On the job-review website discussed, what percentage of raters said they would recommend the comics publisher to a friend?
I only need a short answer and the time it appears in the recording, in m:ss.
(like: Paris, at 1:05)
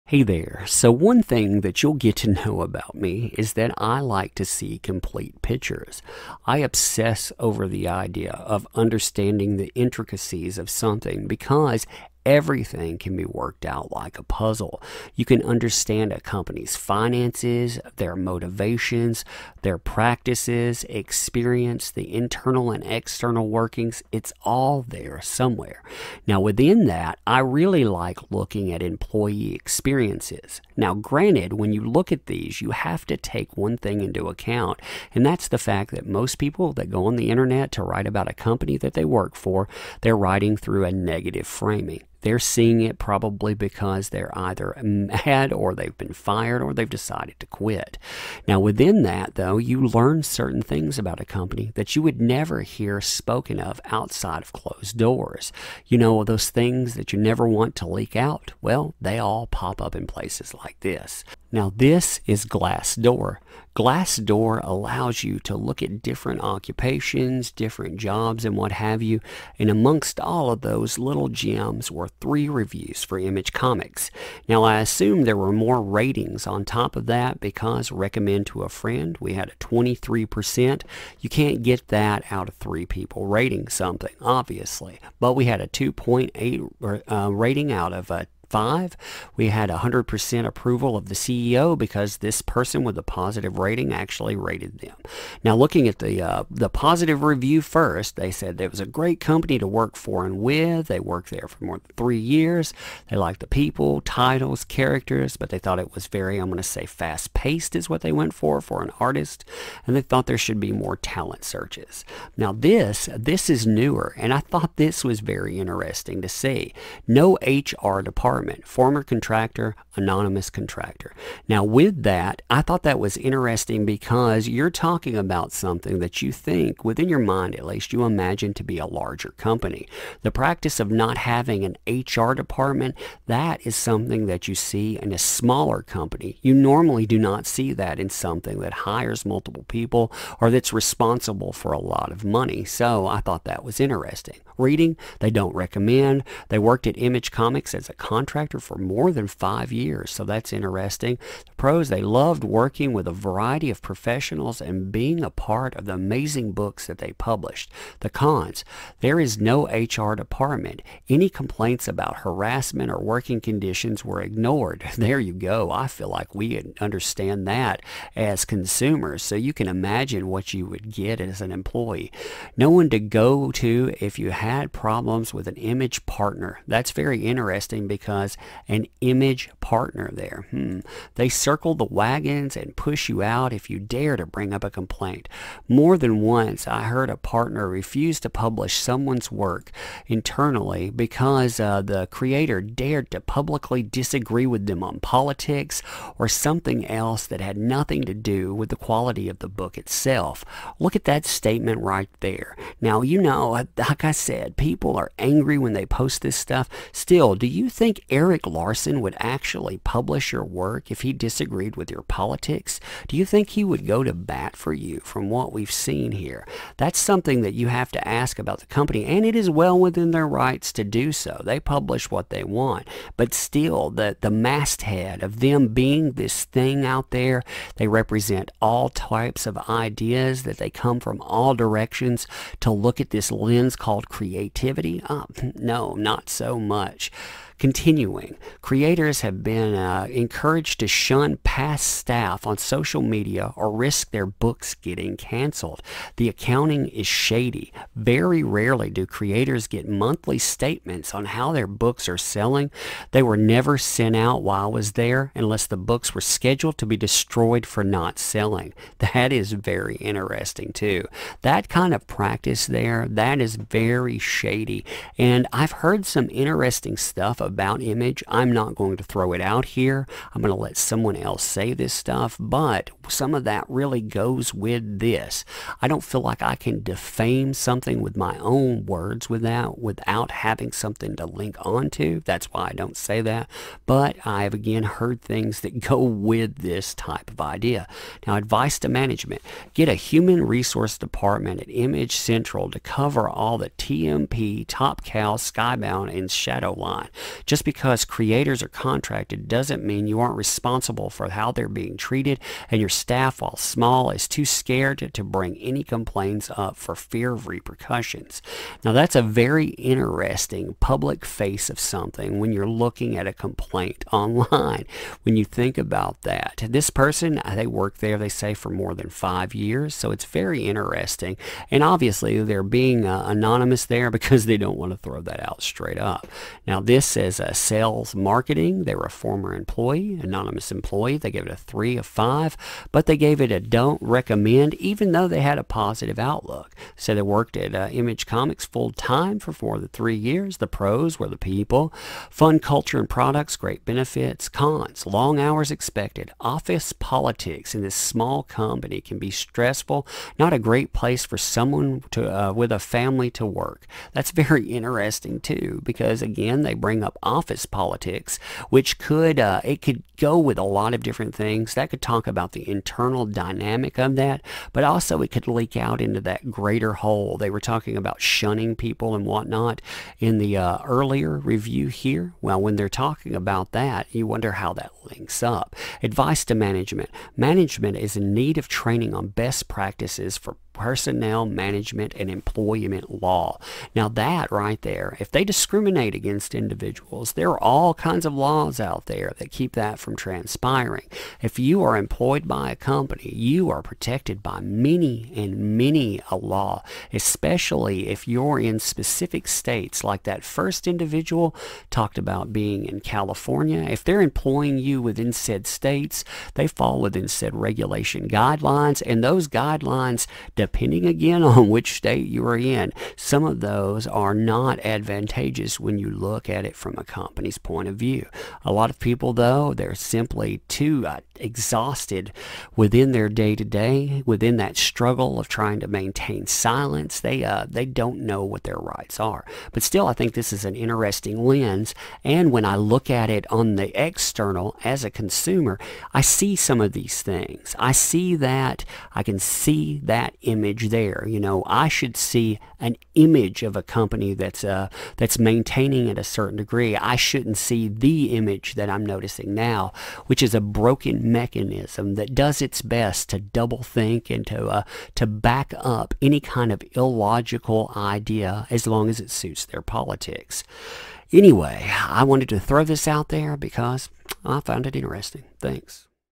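23%, at 1:19.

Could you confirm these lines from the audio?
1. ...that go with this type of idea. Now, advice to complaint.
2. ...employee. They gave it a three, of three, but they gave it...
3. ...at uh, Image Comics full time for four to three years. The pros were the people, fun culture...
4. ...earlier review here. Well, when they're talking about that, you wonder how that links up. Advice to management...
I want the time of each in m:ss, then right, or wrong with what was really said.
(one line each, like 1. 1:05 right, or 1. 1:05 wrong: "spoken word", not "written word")
1. 4:45 wrong: "management", not "complaint"
2. 5:30 wrong: "five", not "three"
3. 5:37 right
4. 6:10 right.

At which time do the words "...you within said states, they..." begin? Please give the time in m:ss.
6:44.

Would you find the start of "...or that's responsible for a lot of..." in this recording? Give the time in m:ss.
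2:20.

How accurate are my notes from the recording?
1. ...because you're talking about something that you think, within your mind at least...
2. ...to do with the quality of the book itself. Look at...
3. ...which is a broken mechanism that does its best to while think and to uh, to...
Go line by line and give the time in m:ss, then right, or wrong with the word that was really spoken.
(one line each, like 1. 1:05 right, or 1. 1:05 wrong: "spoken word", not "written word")
1. 2:03 right
2. 3:18 right
3. 7:30 wrong: "double", not "while".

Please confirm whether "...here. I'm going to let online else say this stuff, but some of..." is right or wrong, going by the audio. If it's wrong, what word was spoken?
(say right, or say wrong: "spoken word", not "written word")
wrong: "someone", not "online".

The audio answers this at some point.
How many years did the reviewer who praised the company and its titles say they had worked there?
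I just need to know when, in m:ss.
1:41.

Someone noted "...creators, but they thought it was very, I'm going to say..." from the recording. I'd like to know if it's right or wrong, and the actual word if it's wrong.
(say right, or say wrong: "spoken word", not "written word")
wrong: "characters", not "creators".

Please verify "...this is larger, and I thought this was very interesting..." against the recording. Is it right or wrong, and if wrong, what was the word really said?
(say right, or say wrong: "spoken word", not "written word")
wrong: "newer", not "larger".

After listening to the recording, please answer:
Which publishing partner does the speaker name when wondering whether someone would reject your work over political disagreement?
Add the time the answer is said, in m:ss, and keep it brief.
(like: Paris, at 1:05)
Erik Larsen, at 3:28.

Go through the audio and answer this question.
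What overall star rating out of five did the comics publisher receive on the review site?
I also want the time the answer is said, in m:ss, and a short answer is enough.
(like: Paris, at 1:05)
2.8, at 1:25.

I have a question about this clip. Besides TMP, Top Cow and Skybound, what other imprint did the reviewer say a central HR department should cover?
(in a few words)
Shadowline.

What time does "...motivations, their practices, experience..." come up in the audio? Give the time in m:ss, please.
0:18.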